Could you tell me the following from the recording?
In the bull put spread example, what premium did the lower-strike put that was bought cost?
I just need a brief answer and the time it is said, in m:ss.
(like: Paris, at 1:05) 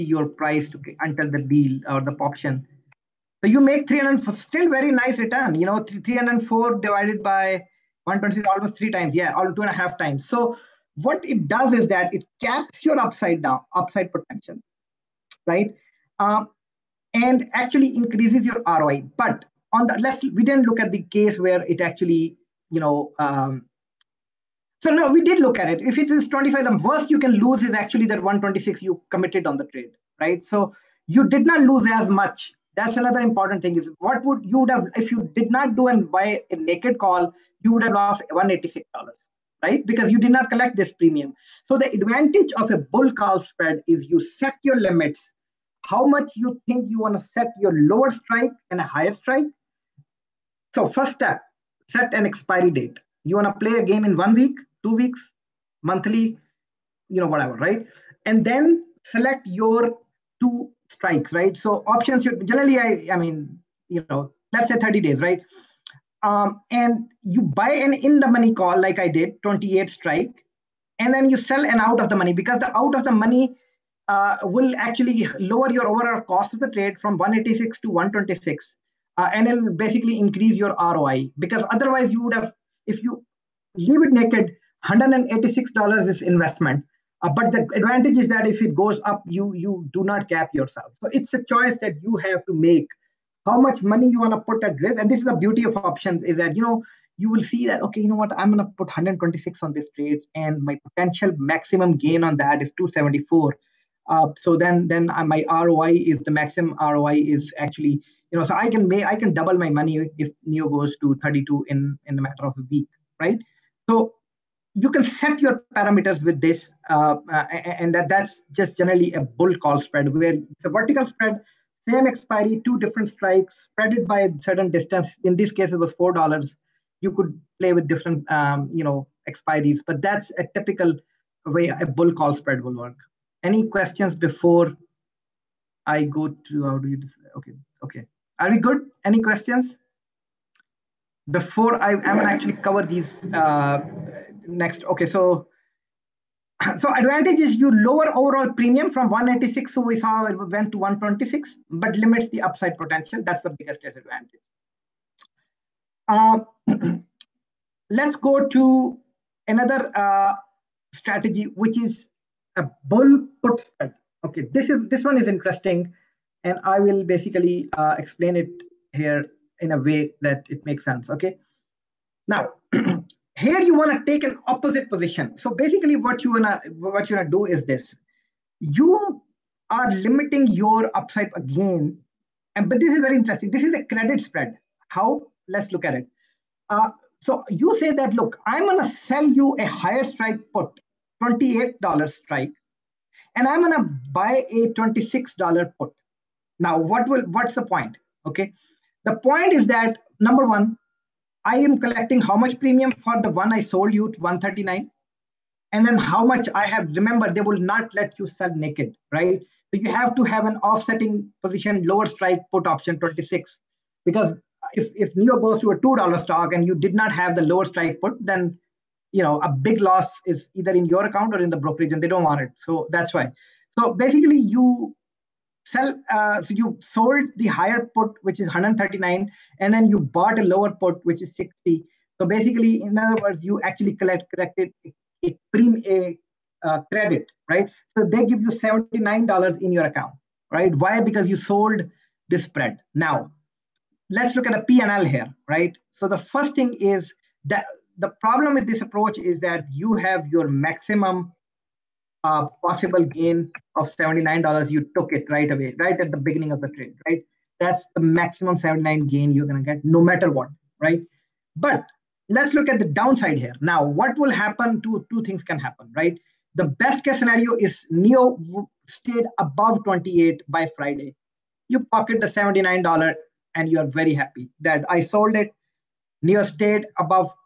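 60, at 3:51.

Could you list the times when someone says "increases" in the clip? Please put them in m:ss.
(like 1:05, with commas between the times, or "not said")
0:17, 1:20.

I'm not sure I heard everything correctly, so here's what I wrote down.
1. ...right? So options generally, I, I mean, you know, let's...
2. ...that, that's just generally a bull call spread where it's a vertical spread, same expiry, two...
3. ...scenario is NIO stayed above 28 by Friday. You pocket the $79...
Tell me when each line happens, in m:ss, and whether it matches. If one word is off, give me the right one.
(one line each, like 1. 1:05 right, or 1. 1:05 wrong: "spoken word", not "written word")
1. 1:01 right
2. 1:57 right
3. 4:27 right.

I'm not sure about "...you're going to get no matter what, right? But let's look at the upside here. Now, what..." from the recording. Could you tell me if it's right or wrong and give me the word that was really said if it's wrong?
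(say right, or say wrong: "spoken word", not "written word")
wrong: "downside", not "upside".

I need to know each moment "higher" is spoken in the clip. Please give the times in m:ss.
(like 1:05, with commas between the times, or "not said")
0:48, 3:09, 3:47.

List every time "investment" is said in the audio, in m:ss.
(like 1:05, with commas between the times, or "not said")
1:26.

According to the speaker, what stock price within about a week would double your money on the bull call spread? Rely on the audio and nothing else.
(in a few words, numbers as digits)
32.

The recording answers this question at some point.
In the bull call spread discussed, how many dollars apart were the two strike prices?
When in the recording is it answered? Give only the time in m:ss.
2:05.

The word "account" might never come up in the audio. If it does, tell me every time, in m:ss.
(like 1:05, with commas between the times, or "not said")
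3:41, 3:59.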